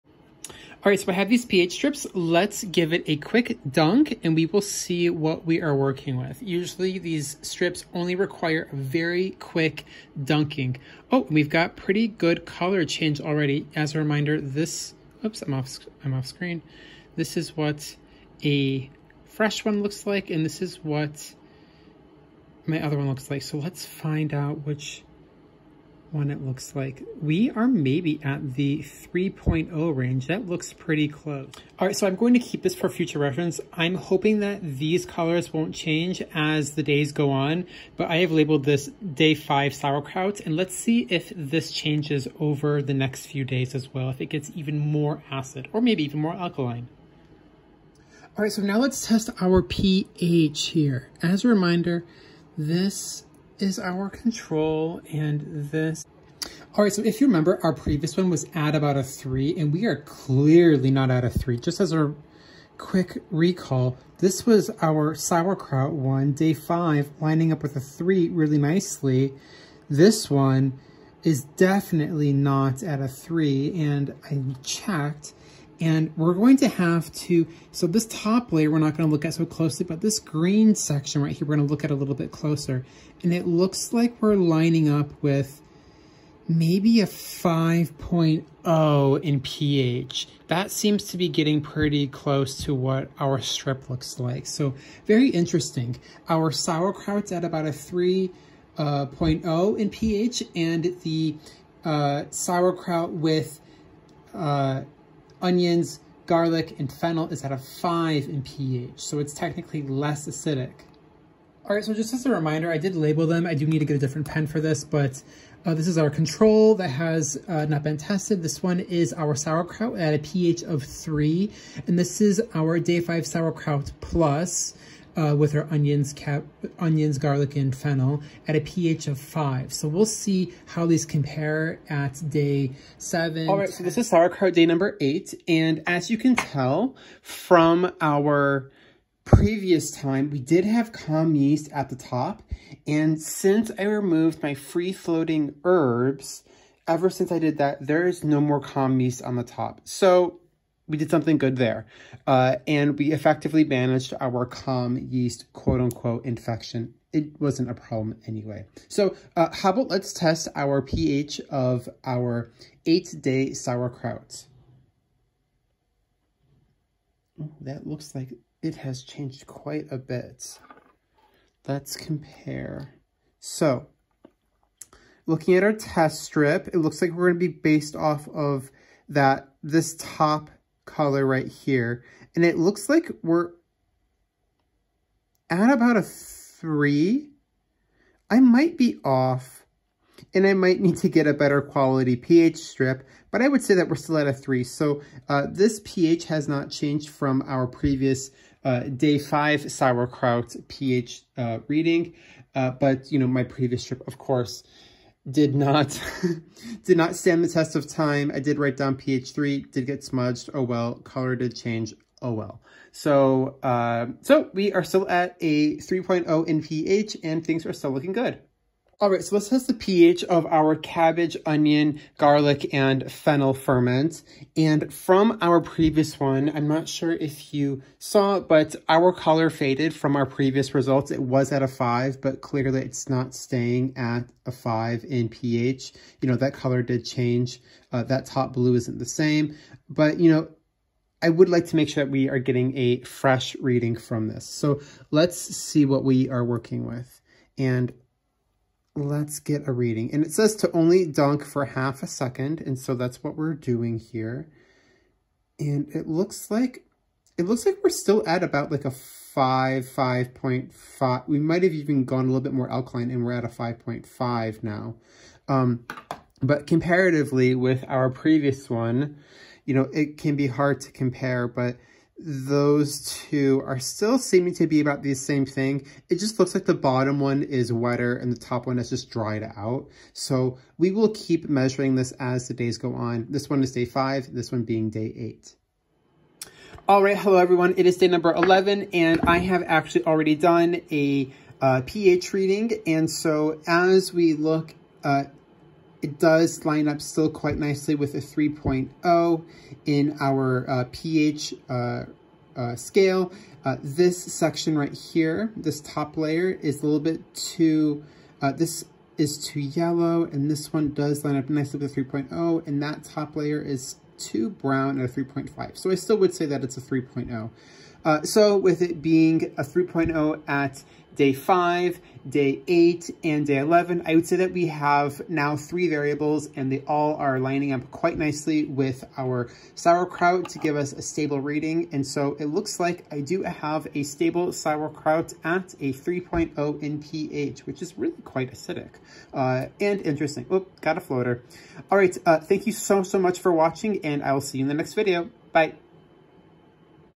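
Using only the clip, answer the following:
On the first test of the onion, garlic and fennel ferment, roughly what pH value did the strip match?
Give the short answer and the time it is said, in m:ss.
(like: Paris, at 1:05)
5.0, at 1:27.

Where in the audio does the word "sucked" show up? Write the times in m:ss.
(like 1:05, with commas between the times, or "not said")
not said.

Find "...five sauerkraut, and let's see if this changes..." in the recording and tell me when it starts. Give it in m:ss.
0:39.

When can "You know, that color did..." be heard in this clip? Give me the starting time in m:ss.
3:56.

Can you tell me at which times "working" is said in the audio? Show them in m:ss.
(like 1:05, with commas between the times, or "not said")
0:05, 4:06.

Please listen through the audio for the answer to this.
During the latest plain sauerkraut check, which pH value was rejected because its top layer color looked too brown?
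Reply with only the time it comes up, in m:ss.
5:15.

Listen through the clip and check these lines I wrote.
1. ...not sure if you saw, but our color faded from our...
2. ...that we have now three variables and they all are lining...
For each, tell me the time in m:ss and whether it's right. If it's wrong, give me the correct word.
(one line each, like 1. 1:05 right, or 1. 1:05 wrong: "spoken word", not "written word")
1. 3:46 right
2. 5:24 right.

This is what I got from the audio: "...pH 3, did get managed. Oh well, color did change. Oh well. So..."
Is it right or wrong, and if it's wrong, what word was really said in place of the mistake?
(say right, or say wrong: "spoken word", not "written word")
wrong: "smudged", not "managed".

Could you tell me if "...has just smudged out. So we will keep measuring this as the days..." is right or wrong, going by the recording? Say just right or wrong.
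wrong.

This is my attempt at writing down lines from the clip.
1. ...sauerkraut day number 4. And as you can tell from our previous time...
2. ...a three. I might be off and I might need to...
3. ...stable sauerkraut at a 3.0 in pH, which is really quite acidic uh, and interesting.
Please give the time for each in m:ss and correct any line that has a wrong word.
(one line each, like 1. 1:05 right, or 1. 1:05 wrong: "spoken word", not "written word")
1. 2:14 wrong: "8", not "4"
2. 3:05 right
3. 5:34 right.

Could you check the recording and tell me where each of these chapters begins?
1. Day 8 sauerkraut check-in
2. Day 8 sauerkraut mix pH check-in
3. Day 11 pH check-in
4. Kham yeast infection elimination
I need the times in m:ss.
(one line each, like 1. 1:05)
1. 2:12
2. 4:05
3. 4:49
4. 2:30.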